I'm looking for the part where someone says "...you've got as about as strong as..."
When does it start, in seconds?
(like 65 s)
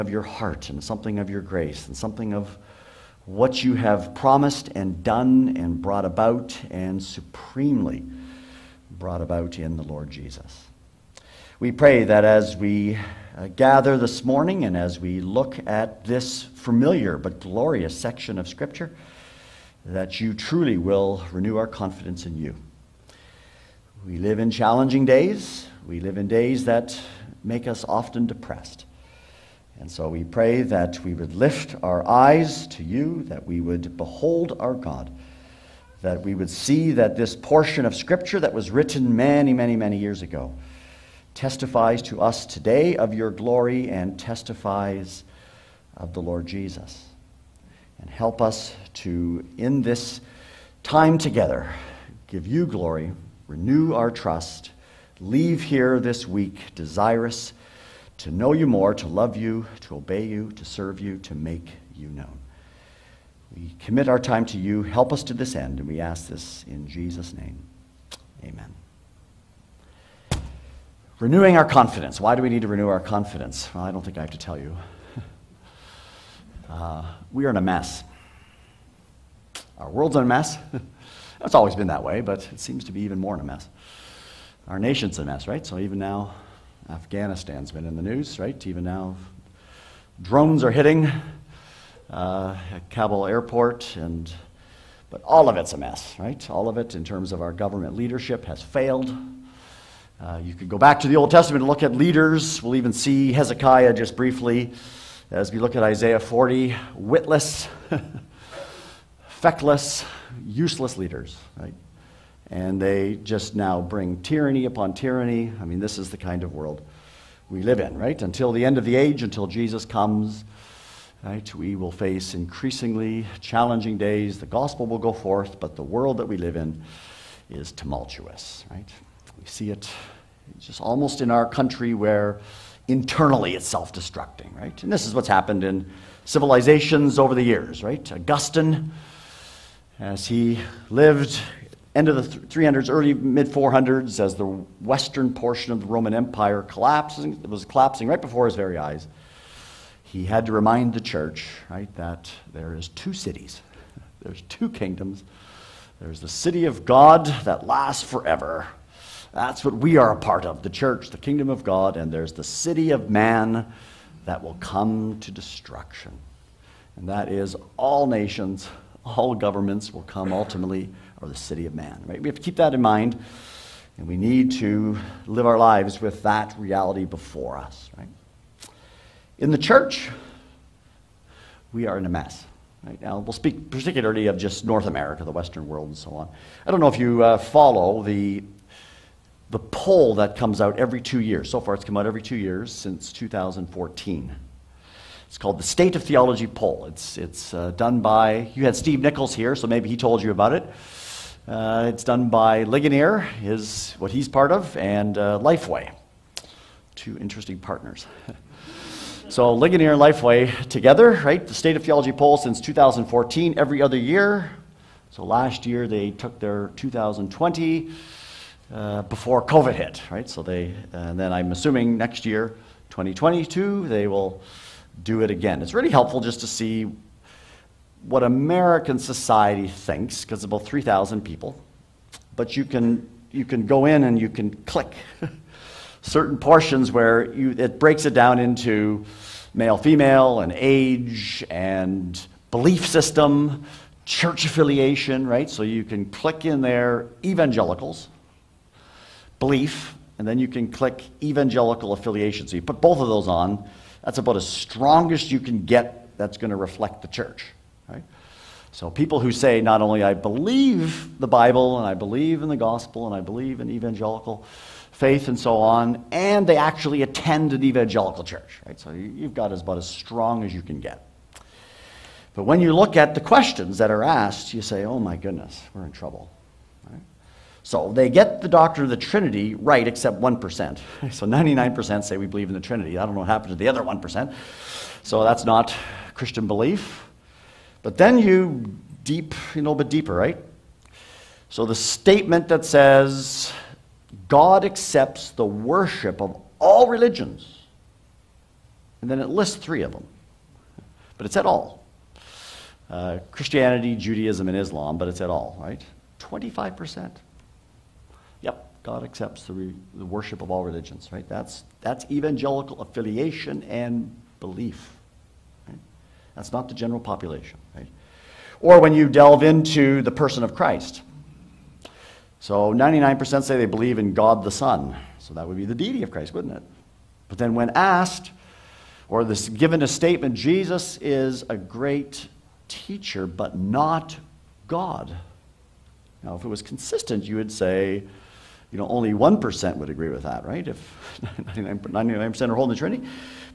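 268 s.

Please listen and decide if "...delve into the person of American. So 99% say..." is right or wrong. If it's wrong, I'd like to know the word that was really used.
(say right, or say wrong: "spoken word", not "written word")
wrong: "Christ", not "American".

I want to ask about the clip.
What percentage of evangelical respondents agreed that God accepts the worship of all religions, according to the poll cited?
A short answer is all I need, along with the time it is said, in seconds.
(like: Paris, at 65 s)
25%, at 306 s.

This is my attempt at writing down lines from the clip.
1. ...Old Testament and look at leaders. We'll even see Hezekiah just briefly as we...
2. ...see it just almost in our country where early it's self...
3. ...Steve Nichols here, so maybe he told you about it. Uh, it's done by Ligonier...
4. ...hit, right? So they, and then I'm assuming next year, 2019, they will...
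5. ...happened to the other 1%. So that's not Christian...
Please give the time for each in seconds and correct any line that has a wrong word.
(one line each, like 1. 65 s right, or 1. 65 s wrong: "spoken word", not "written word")
1. 101 s right
2. 129 s wrong: "internally", not "early"
3. 198 s right
4. 219 s wrong: "2022", not "2019"
5. 283 s right.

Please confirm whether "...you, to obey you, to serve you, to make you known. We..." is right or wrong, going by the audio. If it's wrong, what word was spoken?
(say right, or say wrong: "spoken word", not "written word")
right.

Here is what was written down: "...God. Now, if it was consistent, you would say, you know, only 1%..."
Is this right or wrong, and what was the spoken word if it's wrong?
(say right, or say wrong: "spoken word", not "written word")
right.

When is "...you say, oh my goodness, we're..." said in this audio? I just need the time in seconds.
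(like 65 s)
274 s.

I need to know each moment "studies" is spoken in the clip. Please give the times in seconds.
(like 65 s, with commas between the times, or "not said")
not said.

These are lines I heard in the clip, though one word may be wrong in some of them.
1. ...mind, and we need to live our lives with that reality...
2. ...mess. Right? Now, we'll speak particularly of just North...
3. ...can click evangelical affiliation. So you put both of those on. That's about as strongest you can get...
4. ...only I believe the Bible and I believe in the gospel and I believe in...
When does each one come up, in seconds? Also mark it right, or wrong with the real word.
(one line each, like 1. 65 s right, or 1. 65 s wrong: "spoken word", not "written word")
1. 172 s right
2. 182 s right
3. 250 s right
4. 259 s right.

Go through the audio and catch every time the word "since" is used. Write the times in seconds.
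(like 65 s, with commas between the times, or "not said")
192 s, 212 s.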